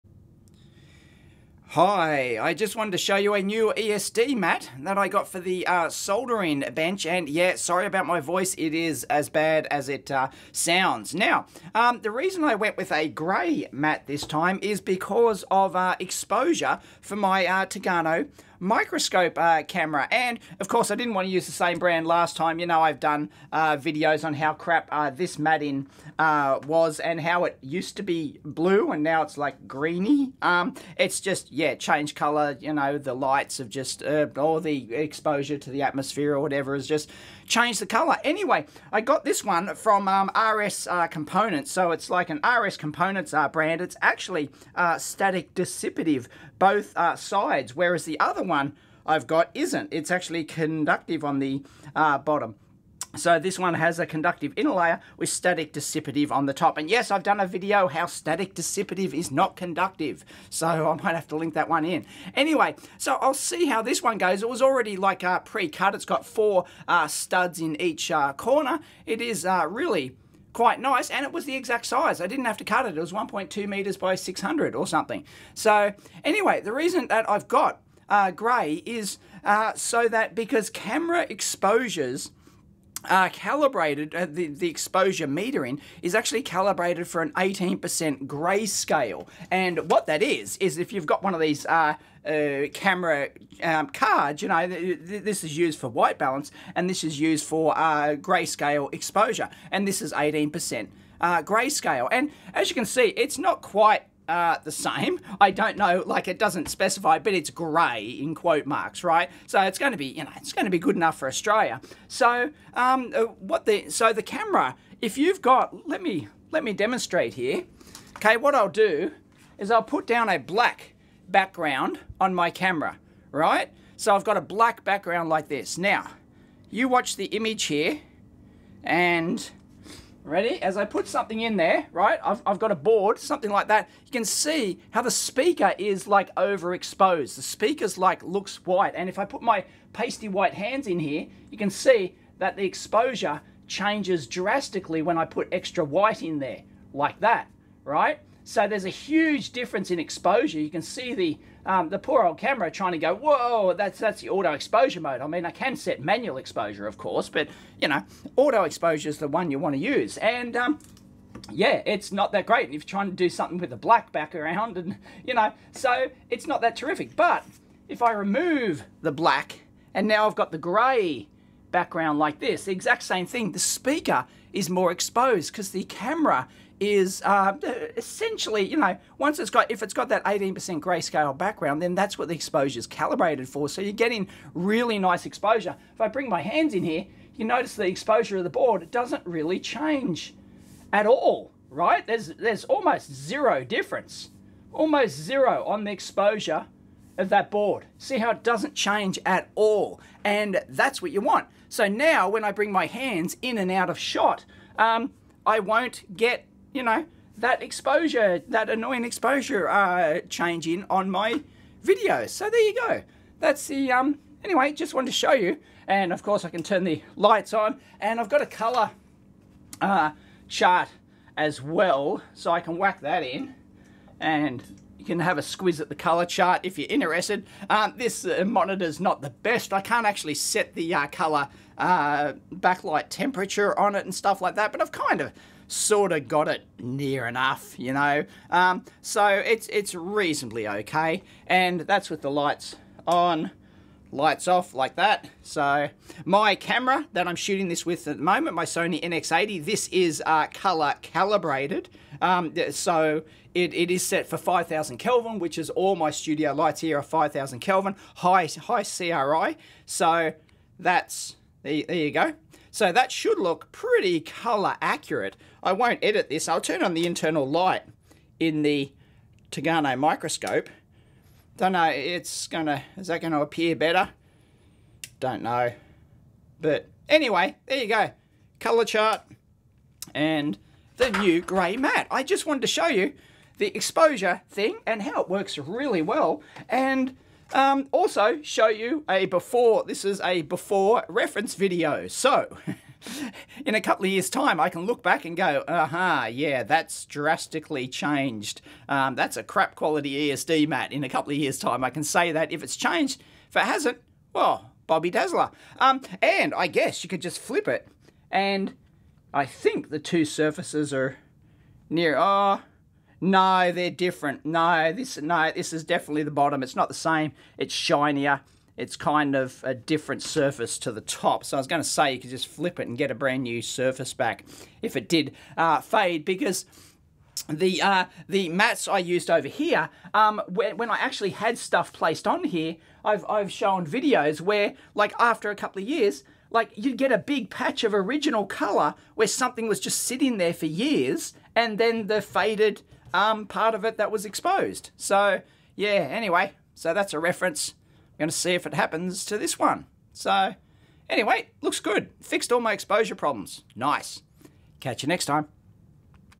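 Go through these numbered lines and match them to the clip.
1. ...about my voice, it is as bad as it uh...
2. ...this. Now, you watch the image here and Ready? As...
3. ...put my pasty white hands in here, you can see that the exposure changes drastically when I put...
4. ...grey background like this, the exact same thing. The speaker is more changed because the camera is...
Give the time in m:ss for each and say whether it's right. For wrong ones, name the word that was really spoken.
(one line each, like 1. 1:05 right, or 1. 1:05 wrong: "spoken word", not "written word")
1. 0:07 right
2. 2:05 right
3. 2:19 right
4. 2:50 wrong: "exposed", not "changed".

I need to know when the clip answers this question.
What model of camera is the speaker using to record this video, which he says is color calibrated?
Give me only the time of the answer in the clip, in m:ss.
4:08.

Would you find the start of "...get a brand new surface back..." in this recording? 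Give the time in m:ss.
5:22.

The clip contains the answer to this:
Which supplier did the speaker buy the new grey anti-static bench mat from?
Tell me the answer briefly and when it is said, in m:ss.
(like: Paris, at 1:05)
RS Components, at 0:40.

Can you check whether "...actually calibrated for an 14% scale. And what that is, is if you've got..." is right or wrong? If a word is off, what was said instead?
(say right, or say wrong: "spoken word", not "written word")
wrong: "18", not "14".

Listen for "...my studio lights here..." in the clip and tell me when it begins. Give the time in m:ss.
4:15.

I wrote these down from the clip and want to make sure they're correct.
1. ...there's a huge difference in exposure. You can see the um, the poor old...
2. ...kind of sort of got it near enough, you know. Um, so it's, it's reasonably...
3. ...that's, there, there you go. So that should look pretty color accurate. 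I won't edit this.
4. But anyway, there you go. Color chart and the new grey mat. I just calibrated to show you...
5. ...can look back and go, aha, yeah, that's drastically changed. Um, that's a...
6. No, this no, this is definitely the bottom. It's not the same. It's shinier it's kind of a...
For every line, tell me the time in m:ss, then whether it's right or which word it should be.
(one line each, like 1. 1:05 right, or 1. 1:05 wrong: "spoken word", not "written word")
1. 2:28 right
2. 3:54 right
3. 4:20 right
4. 4:36 wrong: "wanted", not "calibrated"
5. 4:54 right
6. 5:14 right.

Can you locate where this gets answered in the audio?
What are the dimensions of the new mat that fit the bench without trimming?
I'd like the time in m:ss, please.
1:13.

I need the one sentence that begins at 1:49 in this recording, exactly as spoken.
So it's going to be, you know, it's going to be good enough for Australia.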